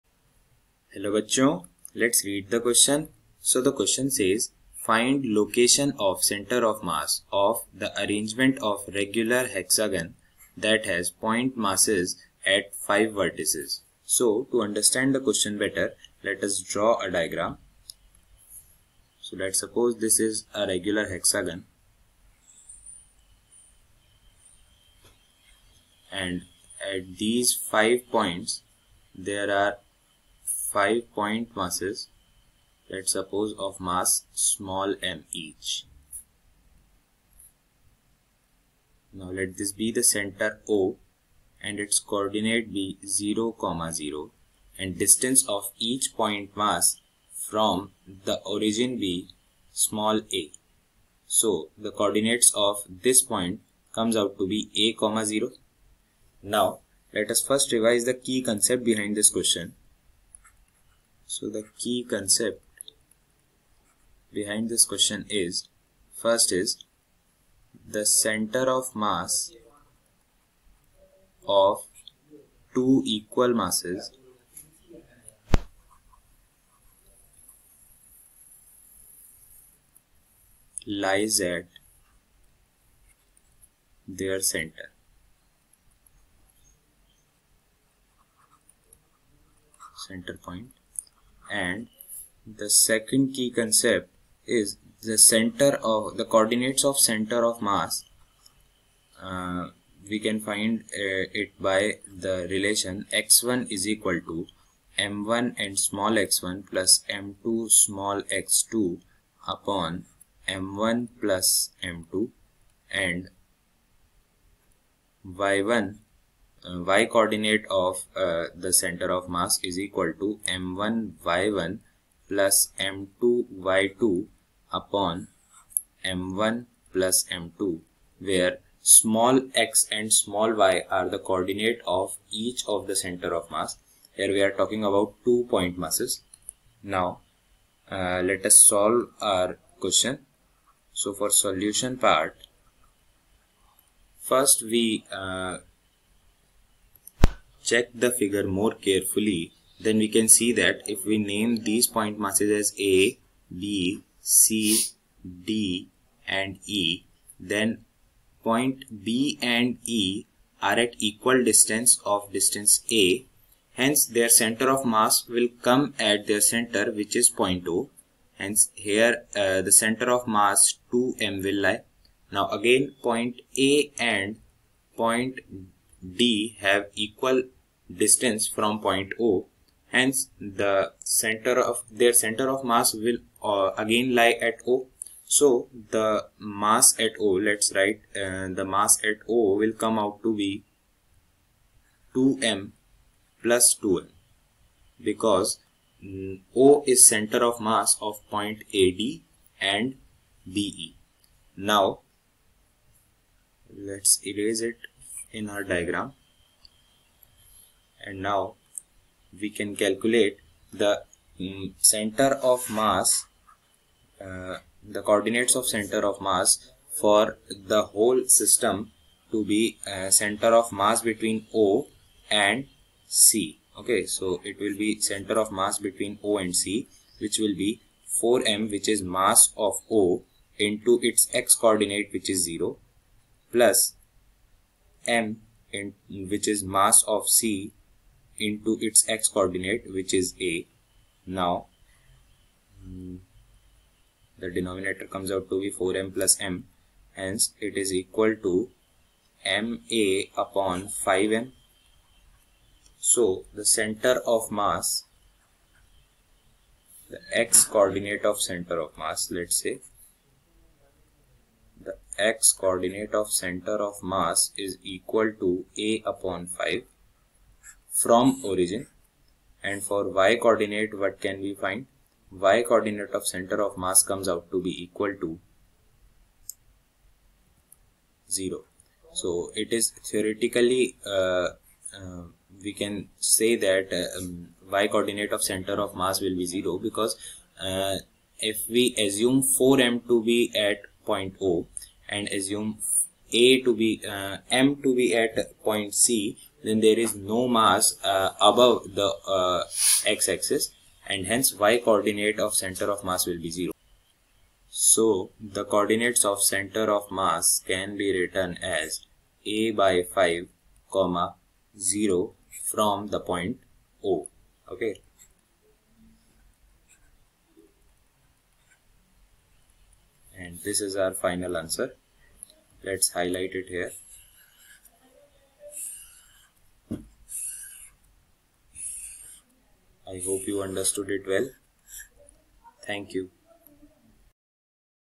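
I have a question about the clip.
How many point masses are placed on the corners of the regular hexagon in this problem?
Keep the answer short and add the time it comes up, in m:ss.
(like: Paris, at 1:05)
5, at 0:30.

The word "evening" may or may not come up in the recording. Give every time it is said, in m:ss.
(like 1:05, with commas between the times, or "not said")
not said.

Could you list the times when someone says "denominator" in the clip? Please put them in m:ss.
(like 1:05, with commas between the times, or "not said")
4:04.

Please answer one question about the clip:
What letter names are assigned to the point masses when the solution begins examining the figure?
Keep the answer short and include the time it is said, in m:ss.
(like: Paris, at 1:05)
A, B, C, D and E, at 2:32.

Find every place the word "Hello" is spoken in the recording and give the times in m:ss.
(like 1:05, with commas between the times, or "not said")
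0:00.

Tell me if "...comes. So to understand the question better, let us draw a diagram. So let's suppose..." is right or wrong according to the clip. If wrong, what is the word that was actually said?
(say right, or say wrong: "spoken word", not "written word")
wrong: "vertices", not "comes".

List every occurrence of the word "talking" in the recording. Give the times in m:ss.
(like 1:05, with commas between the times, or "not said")
2:14.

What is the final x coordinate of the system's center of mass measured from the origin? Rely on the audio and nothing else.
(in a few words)
a/5.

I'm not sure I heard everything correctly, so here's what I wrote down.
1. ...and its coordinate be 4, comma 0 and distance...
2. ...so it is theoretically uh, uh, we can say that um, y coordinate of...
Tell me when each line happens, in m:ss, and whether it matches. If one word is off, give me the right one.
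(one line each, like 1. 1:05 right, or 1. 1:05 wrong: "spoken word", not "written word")
1. 0:41 wrong: "0", not "4"
2. 4:39 right.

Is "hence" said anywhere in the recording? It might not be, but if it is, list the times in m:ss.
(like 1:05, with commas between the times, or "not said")
2:43, 2:48, 2:59, 4:07, 5:01.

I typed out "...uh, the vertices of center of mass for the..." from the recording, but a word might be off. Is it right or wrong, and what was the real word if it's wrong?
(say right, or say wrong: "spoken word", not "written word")
wrong: "coordinates", not "vertices".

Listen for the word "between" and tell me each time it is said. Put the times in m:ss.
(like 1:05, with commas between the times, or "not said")
3:41, 3:45.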